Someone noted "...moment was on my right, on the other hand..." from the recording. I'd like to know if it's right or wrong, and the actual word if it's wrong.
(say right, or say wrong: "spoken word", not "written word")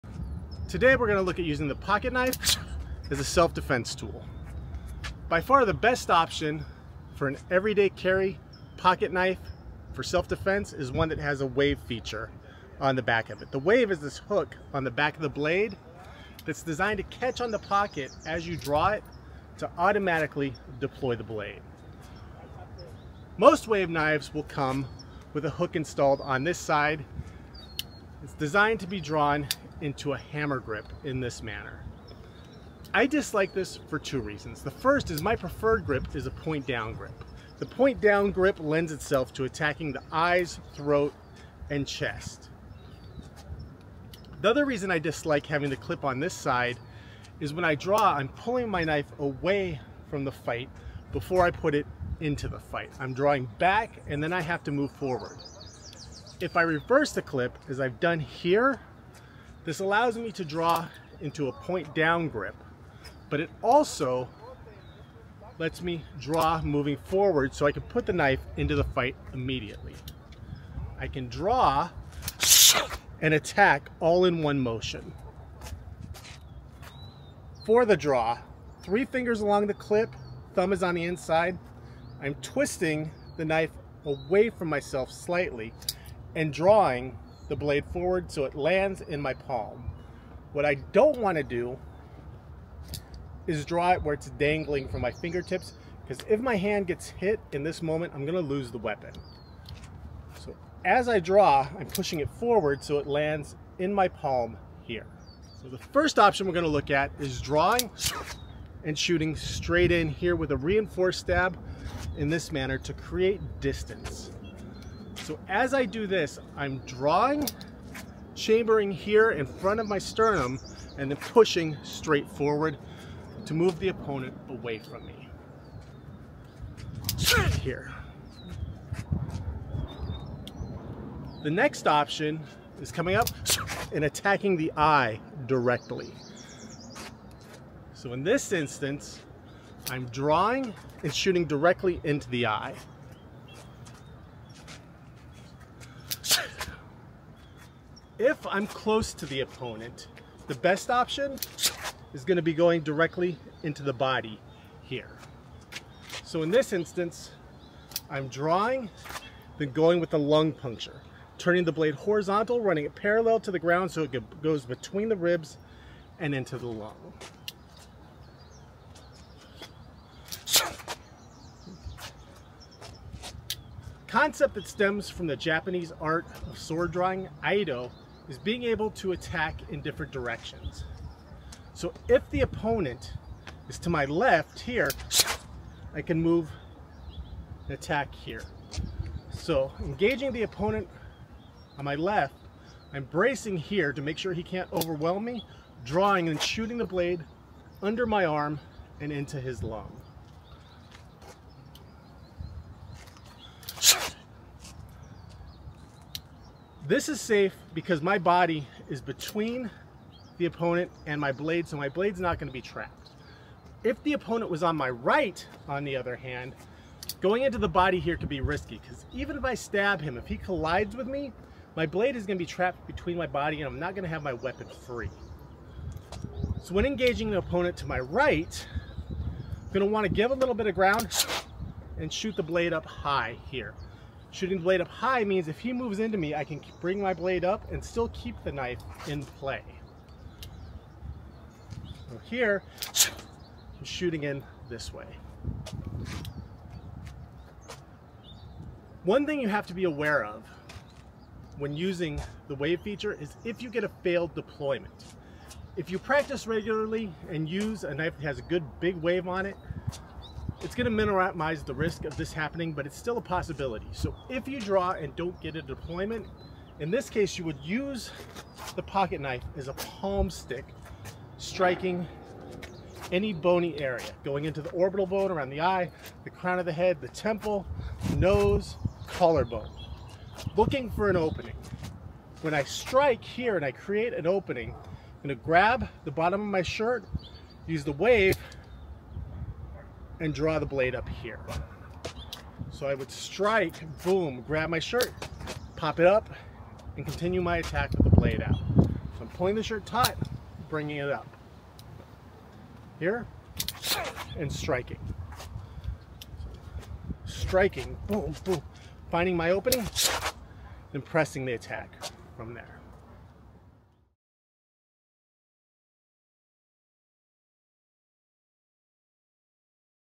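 wrong: "opponent", not "moment".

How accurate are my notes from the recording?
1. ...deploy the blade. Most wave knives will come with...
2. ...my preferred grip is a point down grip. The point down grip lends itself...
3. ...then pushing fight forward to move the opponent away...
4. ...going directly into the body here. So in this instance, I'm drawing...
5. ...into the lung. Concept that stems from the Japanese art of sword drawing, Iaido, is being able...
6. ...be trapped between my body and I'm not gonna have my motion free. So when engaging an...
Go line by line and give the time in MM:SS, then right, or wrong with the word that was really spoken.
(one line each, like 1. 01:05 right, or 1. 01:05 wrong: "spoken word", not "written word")
1. 00:20 right
2. 00:35 right
3. 02:01 wrong: "straight", not "fight"
4. 02:32 right
5. 02:46 right
6. 03:42 wrong: "weapon", not "motion".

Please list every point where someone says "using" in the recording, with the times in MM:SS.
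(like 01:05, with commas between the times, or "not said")
00:01, 04:11.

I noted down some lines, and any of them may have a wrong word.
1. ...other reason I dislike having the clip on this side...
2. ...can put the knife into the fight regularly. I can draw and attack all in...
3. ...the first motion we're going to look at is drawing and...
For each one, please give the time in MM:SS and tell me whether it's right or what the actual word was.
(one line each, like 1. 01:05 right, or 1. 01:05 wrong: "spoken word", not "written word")
1. 00:44 right
2. 01:07 wrong: "immediately", not "regularly"
3. 01:45 wrong: "option", not "motion".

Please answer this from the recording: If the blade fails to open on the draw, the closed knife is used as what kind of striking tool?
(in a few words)
palm stick.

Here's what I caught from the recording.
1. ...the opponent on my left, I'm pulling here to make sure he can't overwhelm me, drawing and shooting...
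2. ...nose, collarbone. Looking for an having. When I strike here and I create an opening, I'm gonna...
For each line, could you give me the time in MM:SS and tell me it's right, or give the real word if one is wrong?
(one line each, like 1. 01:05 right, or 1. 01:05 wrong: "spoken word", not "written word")
1. 03:10 wrong: "bracing", not "pulling"
2. 04:38 wrong: "opening", not "having".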